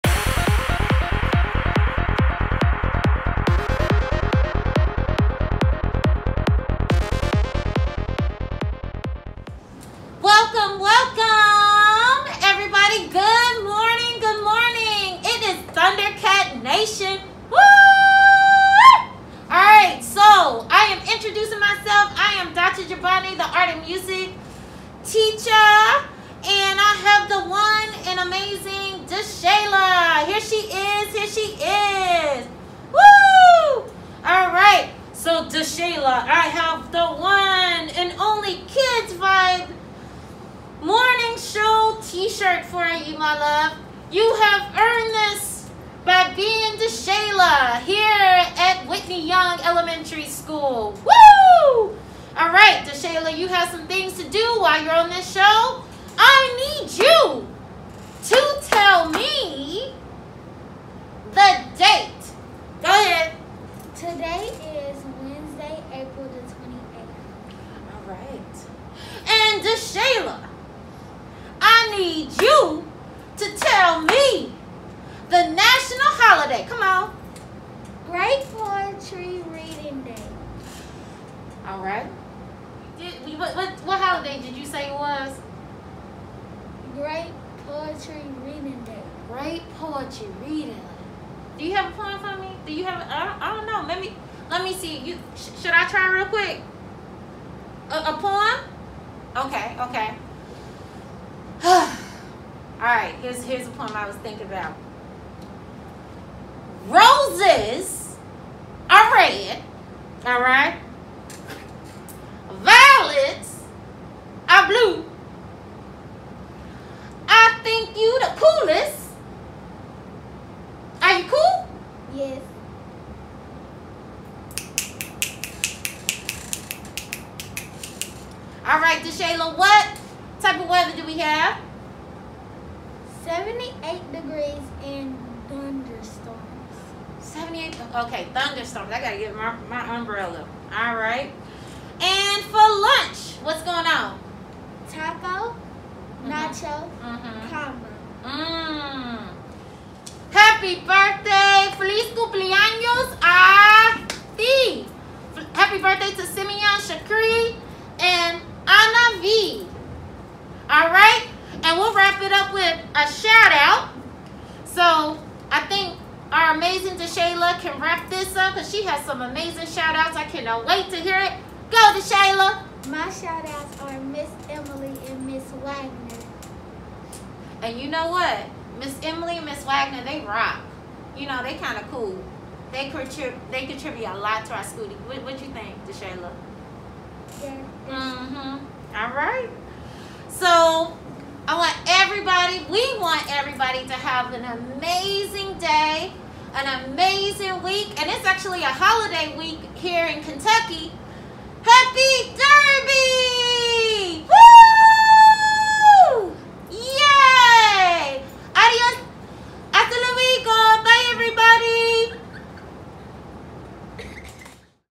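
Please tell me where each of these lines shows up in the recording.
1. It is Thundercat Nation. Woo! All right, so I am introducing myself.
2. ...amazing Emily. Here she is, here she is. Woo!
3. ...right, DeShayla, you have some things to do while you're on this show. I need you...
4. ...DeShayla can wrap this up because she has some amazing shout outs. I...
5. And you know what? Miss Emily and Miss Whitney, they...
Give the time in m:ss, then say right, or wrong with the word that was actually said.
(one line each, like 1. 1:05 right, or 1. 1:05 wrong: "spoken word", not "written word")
1. 0:15 right
2. 0:28 wrong: "DeShayla", not "Emily"
3. 0:52 right
4. 2:46 right
5. 2:57 wrong: "Wagner", not "Whitney".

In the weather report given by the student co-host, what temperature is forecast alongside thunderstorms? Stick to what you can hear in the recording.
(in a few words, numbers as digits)
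78 degrees.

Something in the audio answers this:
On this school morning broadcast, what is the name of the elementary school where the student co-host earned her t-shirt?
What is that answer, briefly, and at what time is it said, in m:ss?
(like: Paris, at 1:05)
Whitney Young Elementary School, at 0:48.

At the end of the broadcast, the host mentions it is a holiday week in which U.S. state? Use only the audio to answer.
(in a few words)
Kentucky.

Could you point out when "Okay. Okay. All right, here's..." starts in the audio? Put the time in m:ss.
1:39.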